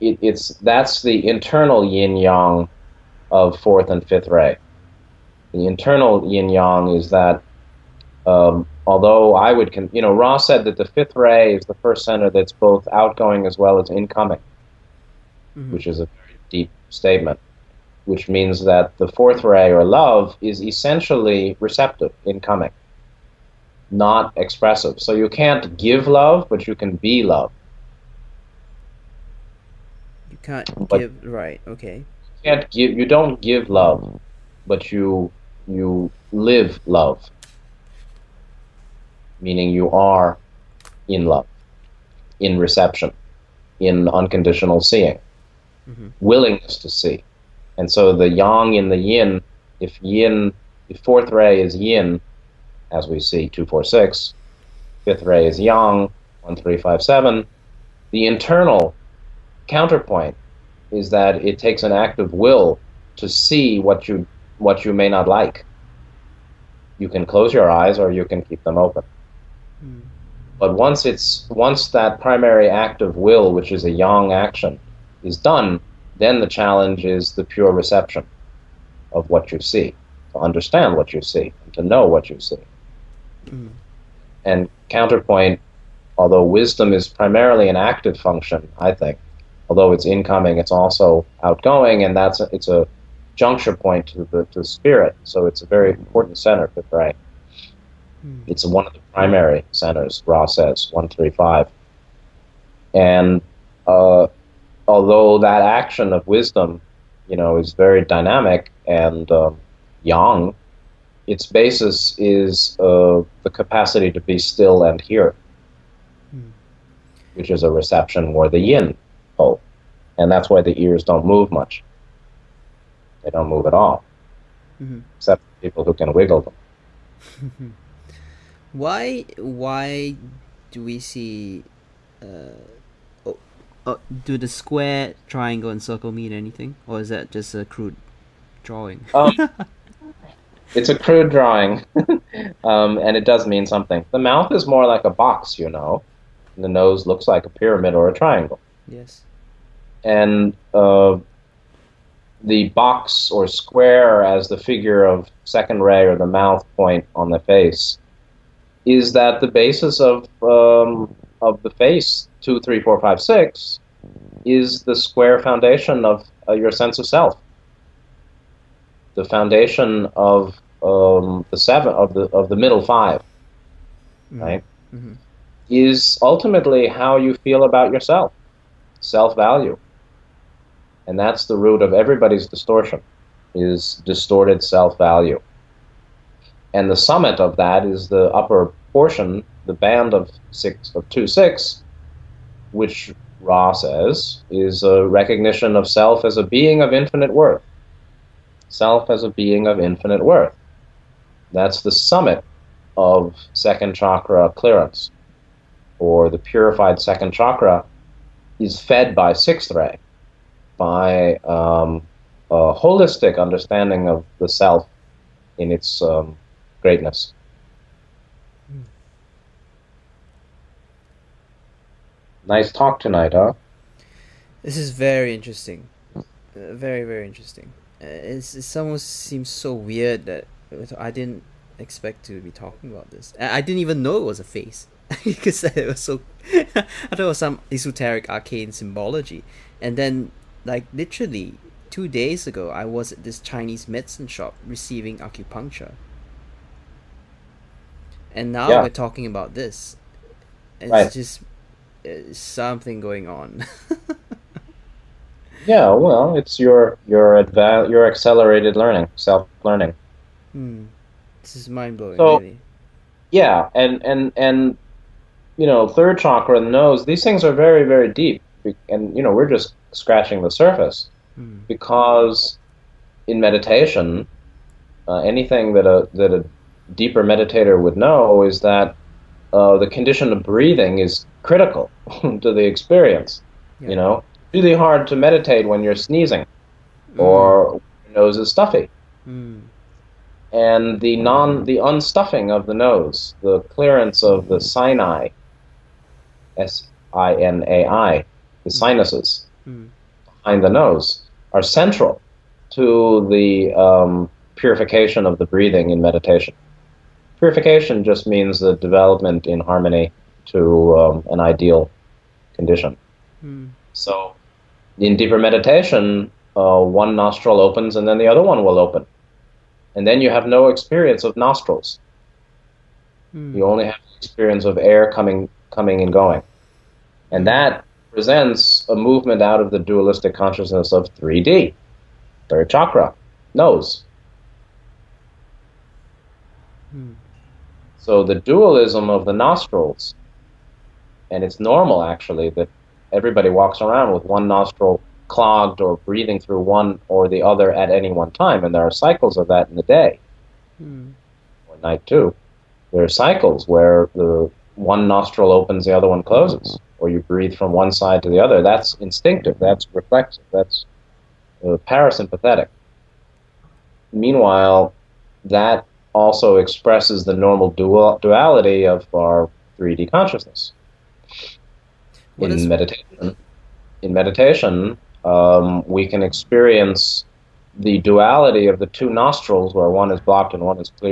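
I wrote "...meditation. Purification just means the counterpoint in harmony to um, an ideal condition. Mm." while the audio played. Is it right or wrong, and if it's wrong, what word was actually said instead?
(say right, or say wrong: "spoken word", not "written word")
wrong: "development", not "counterpoint".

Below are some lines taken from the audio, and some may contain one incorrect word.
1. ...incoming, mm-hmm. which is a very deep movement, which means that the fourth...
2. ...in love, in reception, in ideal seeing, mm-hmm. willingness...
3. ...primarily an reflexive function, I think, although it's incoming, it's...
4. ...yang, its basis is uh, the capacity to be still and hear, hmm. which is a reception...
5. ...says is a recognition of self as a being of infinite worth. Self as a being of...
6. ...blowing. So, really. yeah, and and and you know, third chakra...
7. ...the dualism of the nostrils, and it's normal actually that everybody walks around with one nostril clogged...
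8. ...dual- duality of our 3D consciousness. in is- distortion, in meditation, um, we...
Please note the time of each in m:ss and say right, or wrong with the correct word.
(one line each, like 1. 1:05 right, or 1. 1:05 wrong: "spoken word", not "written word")
1. 0:13 wrong: "statement", not "movement"
2. 0:41 wrong: "unconditional", not "ideal"
3. 1:27 wrong: "active", not "reflexive"
4. 1:50 right
5. 3:13 right
6. 4:21 right
7. 5:38 right
8. 6:07 wrong: "meditation", not "distortion".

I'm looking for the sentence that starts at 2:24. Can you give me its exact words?
The mouth is more like a box, you know.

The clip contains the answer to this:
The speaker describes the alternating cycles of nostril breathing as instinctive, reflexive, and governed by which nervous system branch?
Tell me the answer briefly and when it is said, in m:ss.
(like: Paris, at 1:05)
Parasympathetic, at 6:01.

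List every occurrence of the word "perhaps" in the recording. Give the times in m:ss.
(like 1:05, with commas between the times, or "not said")
not said.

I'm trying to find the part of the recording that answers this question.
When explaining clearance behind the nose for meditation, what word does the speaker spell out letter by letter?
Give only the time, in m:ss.
4:54.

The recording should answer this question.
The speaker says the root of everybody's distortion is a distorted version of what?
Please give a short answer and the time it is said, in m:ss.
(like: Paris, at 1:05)
Self-value, at 3:04.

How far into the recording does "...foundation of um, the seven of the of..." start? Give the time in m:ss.
2:49.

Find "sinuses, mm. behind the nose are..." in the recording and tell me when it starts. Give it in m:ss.
4:58.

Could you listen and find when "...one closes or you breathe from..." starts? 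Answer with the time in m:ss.
5:56.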